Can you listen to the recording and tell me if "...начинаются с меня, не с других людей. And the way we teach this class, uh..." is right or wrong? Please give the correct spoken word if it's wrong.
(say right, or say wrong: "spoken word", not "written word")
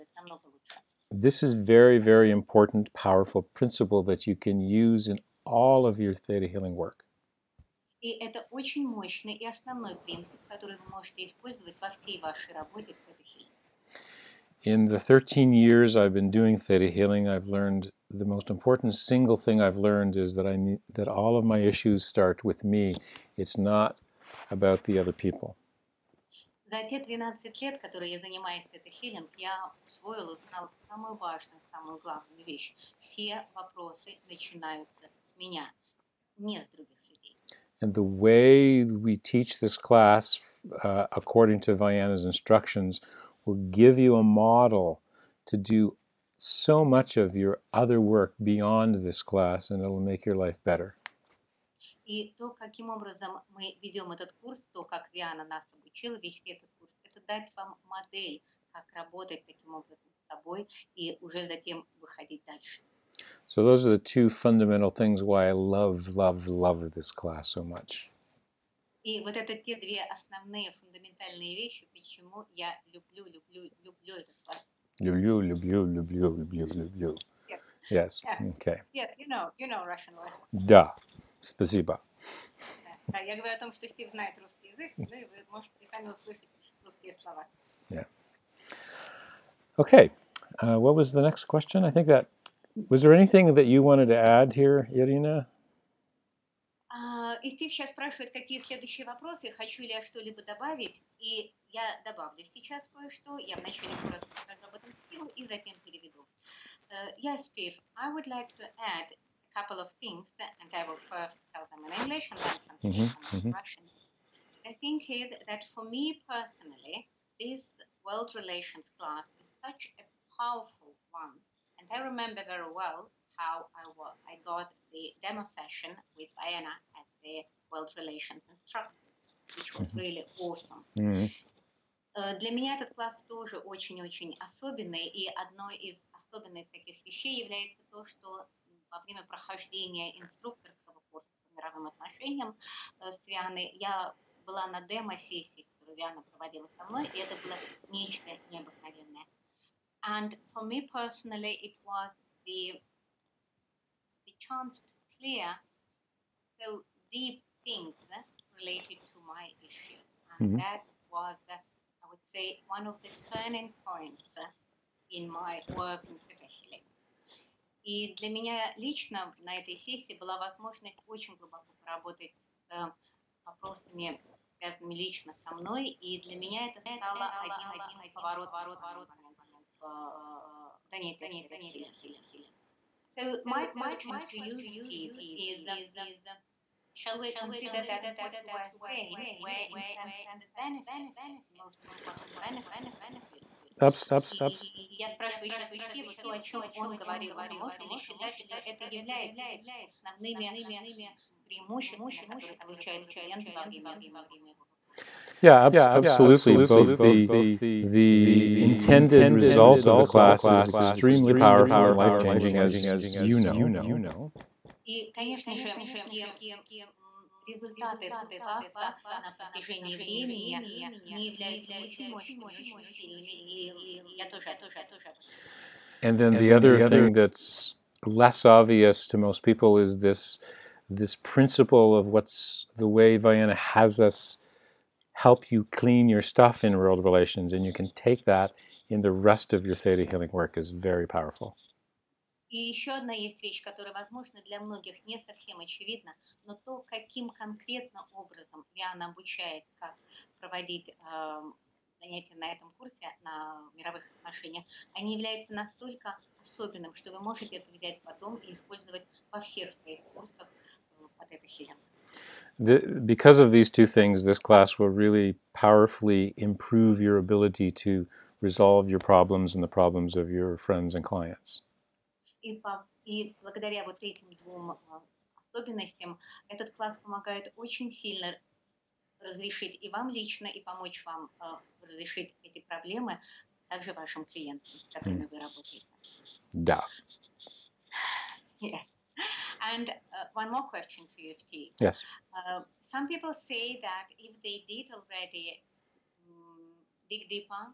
right.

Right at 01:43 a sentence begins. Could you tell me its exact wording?
Я вначале коротко расскажу об этом стилу и затем переведу.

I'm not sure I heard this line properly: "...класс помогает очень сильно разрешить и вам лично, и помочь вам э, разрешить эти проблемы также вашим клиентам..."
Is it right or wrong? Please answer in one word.
right.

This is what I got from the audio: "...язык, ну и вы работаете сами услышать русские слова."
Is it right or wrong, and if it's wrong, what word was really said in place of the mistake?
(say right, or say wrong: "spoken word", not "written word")
wrong: "можете", not "работаете".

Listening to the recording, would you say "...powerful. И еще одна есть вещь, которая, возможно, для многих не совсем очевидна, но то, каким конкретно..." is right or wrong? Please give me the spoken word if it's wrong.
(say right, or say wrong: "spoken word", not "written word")
right.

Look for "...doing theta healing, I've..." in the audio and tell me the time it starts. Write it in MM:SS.
00:16.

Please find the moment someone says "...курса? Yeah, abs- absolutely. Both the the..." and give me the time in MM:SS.
03:24.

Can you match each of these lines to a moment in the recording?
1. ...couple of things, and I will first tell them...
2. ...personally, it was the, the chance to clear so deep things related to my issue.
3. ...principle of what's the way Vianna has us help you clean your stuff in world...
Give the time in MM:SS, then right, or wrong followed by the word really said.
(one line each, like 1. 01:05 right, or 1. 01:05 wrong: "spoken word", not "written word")
1. 01:49 right
2. 02:30 right
3. 03:51 right.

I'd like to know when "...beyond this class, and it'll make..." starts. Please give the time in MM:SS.
00:48.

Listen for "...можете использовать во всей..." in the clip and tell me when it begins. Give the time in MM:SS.
00:10.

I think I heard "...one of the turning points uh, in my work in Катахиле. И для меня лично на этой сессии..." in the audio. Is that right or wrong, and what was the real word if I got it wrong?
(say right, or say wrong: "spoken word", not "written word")
right.